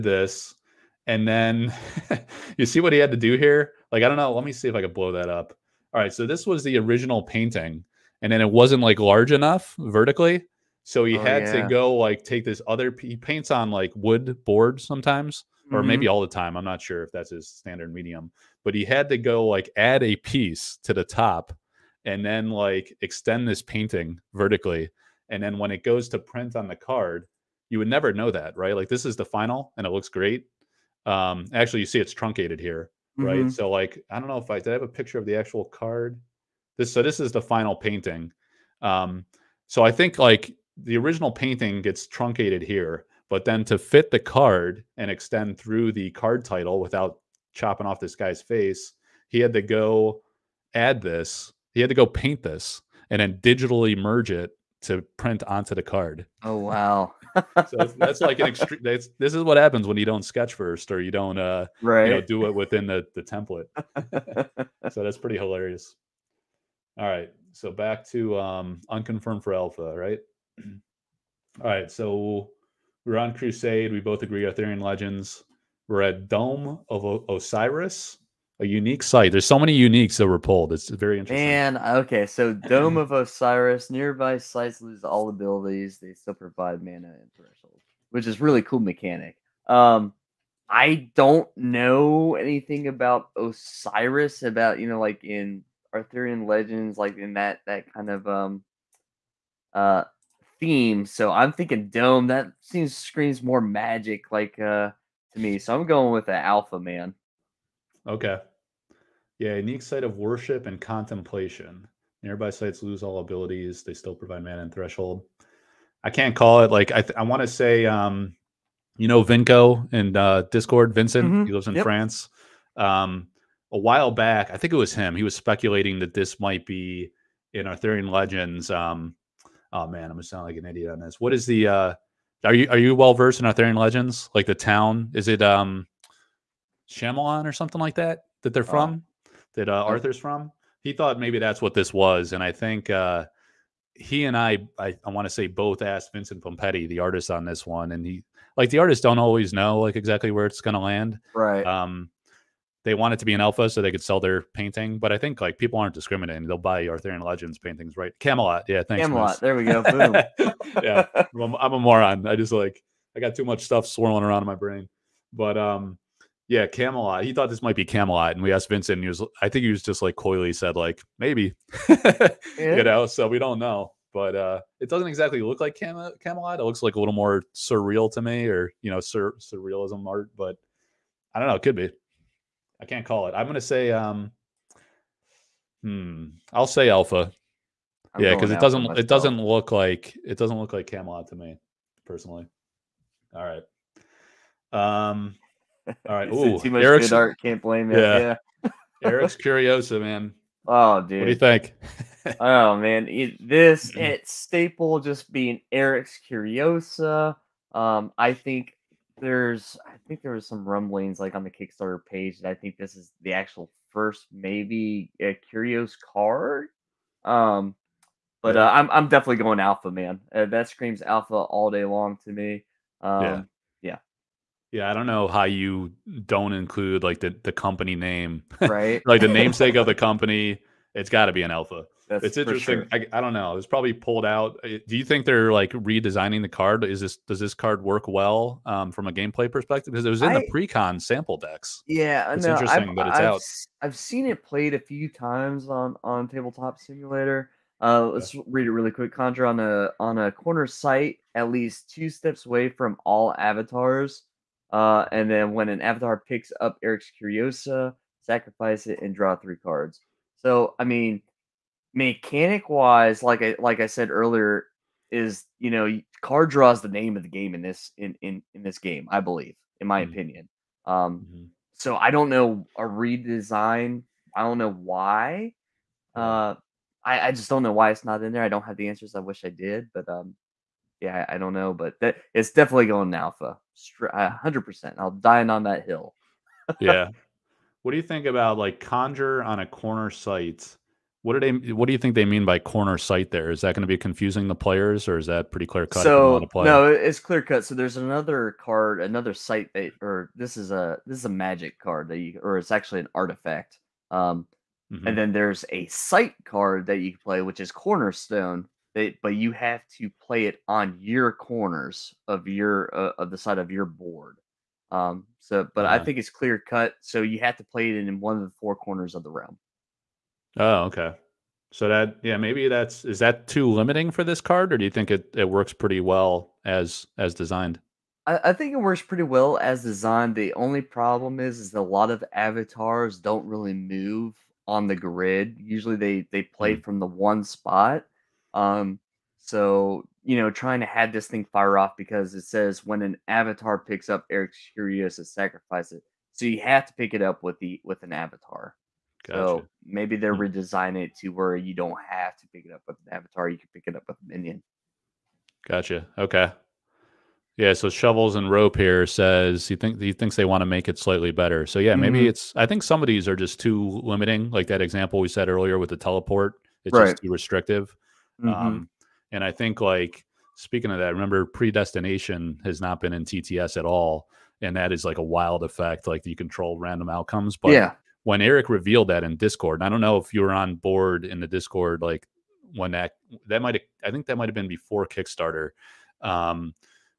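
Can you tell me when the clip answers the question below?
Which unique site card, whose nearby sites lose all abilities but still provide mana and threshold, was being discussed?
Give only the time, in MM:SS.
01:22.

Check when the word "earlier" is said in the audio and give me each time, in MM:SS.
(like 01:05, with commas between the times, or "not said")
04:24, 06:05.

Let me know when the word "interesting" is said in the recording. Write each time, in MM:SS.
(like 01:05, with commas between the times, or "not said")
01:21, 03:52, 04:02.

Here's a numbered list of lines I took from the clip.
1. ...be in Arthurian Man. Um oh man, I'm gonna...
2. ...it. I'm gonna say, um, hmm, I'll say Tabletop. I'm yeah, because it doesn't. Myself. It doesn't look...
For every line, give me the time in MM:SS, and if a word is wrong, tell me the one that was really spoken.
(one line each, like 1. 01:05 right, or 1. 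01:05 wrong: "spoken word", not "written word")
1. 02:06 wrong: "Legends", not "Man"
2. 03:03 wrong: "Alpha", not "Tabletop".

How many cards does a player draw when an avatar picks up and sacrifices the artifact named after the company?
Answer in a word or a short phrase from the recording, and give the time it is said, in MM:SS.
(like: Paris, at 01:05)
3, at 04:19.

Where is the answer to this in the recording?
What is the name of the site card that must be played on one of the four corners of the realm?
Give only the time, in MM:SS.
05:07.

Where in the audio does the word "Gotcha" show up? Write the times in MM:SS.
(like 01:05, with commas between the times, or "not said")
05:49, 05:55.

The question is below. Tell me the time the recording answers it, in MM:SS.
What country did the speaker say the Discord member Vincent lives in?
02:01.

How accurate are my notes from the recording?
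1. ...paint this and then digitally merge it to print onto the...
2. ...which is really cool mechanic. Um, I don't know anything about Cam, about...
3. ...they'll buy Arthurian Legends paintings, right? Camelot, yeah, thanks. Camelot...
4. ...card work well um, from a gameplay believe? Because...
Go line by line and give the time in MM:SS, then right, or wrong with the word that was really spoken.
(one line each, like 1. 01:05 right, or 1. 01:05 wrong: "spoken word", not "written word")
1. 00:52 right
2. 01:28 wrong: "Osiris", not "Cam"
3. 02:36 right
4. 03:57 wrong: "perspective", not "believe".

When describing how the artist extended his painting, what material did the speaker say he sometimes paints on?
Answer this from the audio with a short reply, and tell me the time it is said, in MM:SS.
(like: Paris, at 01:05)
wood board, at 00:13.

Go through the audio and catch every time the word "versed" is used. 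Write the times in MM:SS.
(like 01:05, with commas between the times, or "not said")
02:13.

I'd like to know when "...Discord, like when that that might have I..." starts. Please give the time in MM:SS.
06:21.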